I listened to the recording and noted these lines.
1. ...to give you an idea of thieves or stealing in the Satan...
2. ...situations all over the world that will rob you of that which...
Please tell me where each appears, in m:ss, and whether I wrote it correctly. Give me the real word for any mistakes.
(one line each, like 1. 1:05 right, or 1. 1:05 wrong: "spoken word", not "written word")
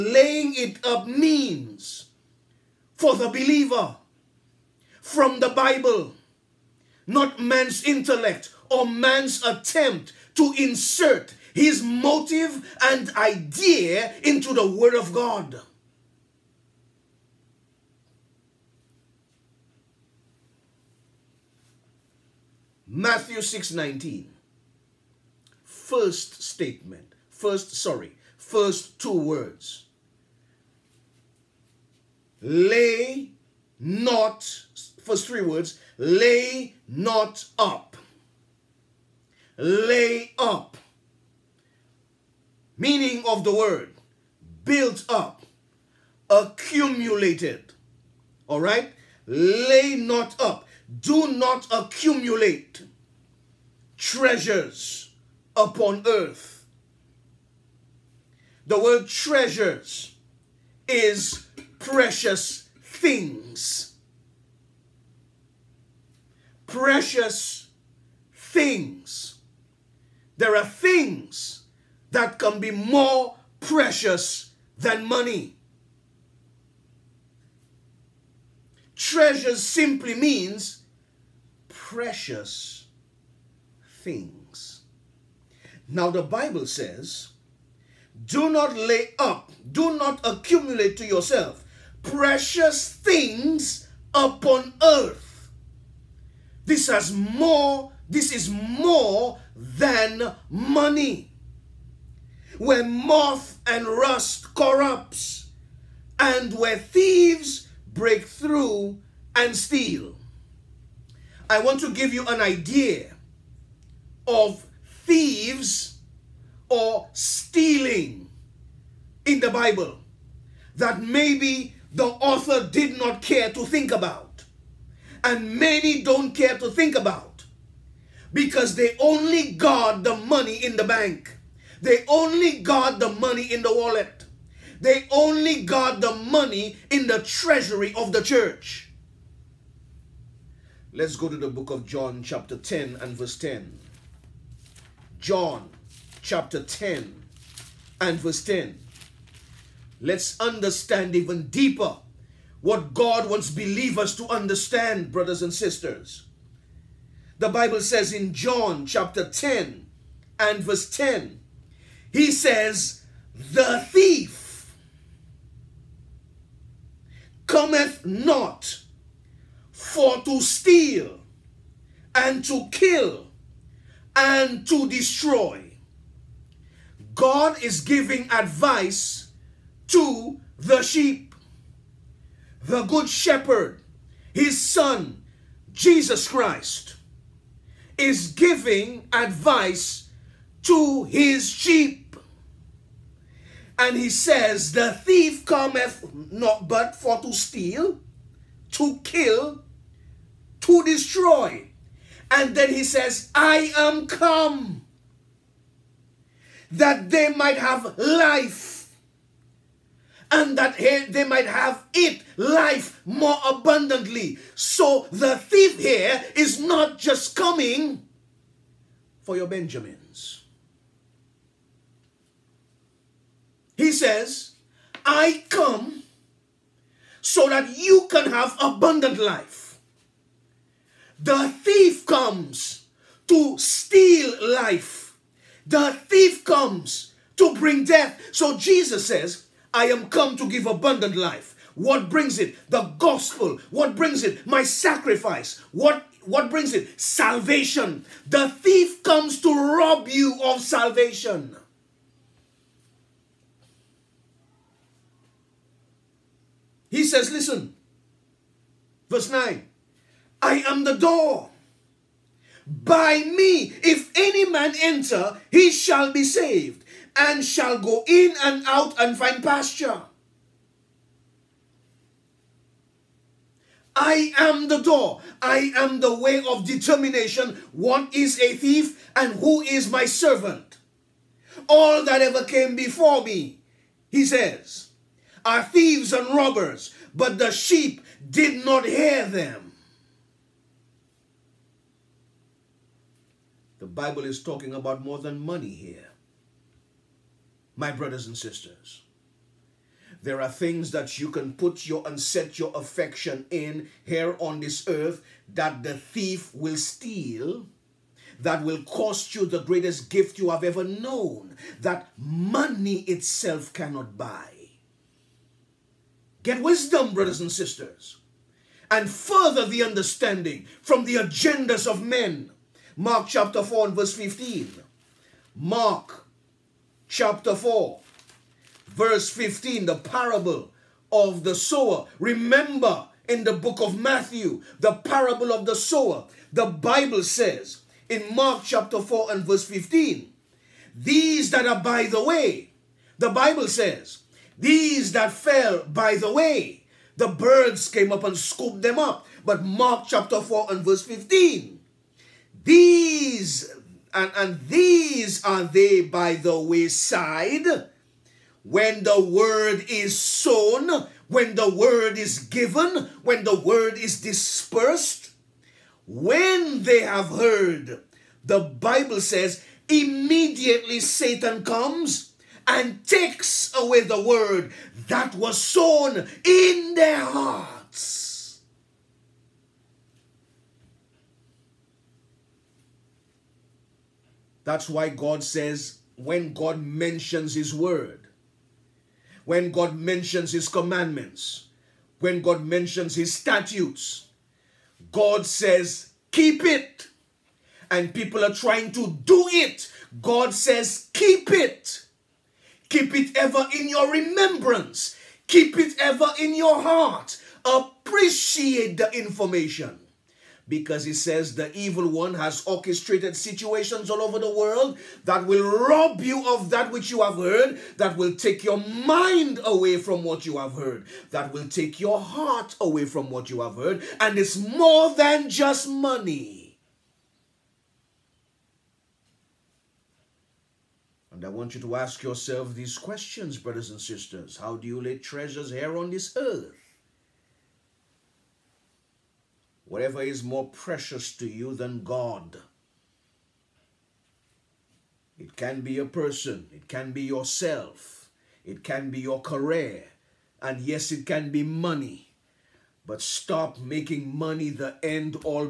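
1. 1:51 wrong: "Bible", not "Satan"
2. 6:53 right.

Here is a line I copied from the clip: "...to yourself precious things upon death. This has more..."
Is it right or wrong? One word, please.
wrong.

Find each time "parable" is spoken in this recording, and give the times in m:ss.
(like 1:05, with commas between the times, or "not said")
5:30, 5:35.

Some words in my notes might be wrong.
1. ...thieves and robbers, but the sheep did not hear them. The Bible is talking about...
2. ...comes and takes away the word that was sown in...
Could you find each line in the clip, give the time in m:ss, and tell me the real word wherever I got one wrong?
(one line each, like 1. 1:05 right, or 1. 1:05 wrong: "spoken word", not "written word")
1. 4:45 right
2. 6:11 right.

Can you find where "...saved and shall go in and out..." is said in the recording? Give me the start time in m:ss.
4:26.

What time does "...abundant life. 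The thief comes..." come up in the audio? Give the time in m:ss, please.
3:48.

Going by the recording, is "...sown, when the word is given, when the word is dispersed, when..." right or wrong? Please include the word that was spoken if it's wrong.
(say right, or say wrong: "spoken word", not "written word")
right.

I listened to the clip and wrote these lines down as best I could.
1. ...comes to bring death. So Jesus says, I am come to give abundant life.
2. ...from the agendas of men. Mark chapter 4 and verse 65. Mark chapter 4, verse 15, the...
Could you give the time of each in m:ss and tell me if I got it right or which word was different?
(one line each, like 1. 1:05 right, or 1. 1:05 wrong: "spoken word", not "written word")
1. 3:56 right
2. 5:20 wrong: "15", not "65".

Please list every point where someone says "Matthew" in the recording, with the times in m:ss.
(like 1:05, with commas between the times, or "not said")
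0:22, 5:34.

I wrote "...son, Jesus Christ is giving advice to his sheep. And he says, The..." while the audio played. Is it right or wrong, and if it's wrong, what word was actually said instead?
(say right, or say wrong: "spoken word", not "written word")
right.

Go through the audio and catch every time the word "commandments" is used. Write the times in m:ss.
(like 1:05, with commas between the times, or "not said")
6:30.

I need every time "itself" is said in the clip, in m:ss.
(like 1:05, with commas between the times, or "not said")
5:13.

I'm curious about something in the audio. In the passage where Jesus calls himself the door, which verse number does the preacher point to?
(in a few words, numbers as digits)
Verse 9.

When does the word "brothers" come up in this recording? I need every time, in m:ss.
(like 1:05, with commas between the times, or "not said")
2:35, 4:57, 5:17, 7:13.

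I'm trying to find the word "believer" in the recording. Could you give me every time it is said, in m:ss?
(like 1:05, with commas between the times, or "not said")
0:03, 2:33.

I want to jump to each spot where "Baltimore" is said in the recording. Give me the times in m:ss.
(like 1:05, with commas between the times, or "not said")
not said.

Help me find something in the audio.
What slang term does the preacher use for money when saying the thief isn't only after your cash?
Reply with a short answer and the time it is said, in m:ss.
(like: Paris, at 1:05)
Benjamins, at 3:39.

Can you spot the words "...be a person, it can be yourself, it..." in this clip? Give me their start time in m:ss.
7:25.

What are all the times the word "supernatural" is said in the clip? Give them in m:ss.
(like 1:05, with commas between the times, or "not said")
not said.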